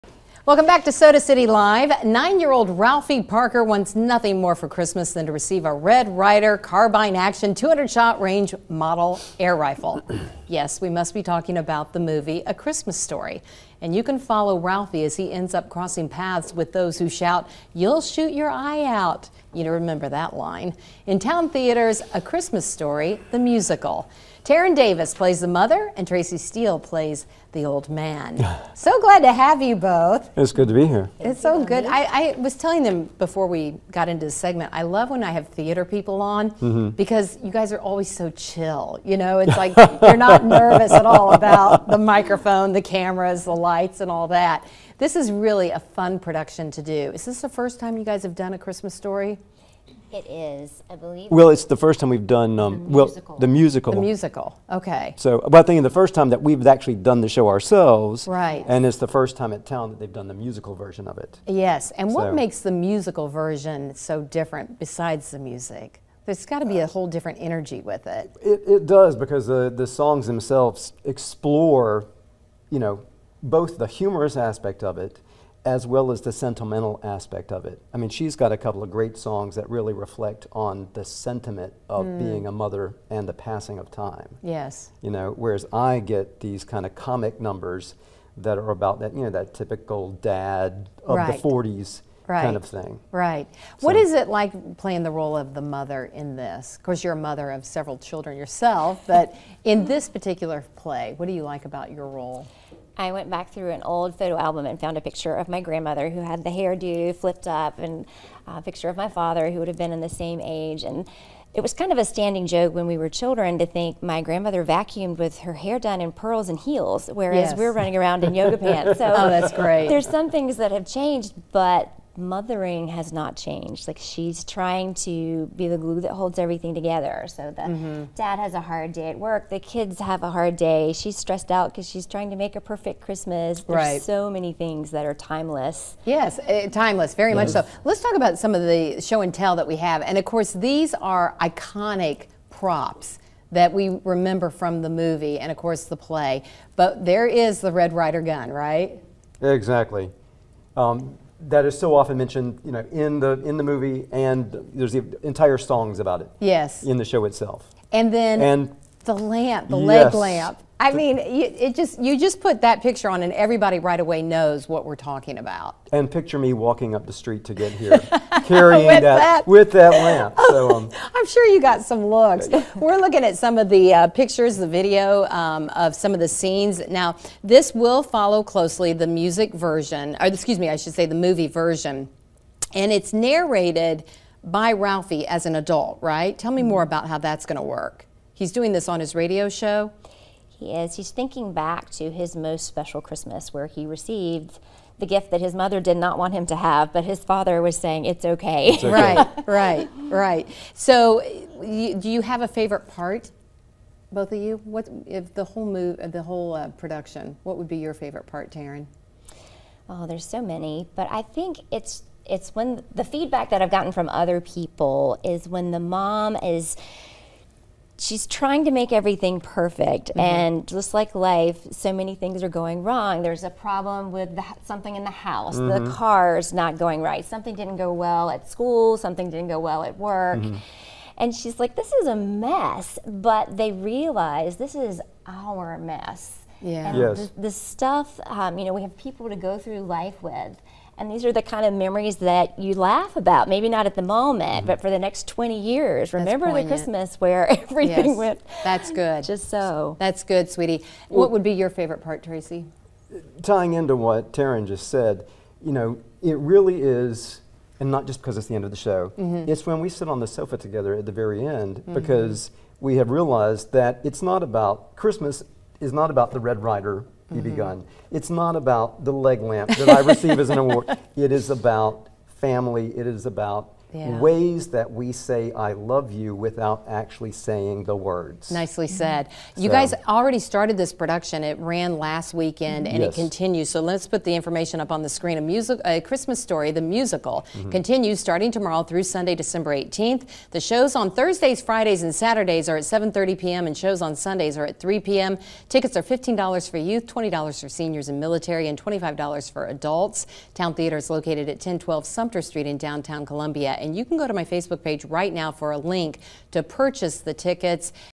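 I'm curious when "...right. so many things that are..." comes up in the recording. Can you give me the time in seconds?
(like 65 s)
133 s.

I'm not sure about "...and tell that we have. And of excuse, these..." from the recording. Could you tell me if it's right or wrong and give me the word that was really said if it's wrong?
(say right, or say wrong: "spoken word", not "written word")
wrong: "course", not "excuse".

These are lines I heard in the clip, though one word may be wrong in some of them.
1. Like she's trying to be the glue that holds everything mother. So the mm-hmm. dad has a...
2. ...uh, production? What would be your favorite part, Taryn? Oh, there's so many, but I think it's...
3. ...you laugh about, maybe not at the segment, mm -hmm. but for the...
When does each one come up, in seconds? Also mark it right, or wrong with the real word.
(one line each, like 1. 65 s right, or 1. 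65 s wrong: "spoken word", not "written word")
1. 123 s wrong: "together", not "mother"
2. 206 s right
3. 242 s wrong: "moment", not "segment".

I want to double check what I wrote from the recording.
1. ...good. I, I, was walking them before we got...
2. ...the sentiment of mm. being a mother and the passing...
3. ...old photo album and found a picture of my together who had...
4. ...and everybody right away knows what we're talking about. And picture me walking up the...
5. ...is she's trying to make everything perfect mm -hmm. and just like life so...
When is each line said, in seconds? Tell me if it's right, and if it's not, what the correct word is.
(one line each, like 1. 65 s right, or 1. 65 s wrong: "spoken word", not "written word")
1. 31 s wrong: "telling", not "walking"
2. 80 s right
3. 103 s wrong: "grandmother", not "together"
4. 163 s right
5. 216 s right.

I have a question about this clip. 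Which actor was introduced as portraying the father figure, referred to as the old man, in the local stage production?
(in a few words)
Tracy Steele.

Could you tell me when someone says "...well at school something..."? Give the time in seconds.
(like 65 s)
228 s.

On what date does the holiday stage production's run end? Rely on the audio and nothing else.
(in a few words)
Sunday, December 18th.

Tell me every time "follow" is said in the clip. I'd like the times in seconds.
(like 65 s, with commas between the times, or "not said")
14 s, 178 s.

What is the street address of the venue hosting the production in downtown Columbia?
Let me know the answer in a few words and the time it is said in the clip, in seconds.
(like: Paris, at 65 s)
1012 Sumter Street, at 301 s.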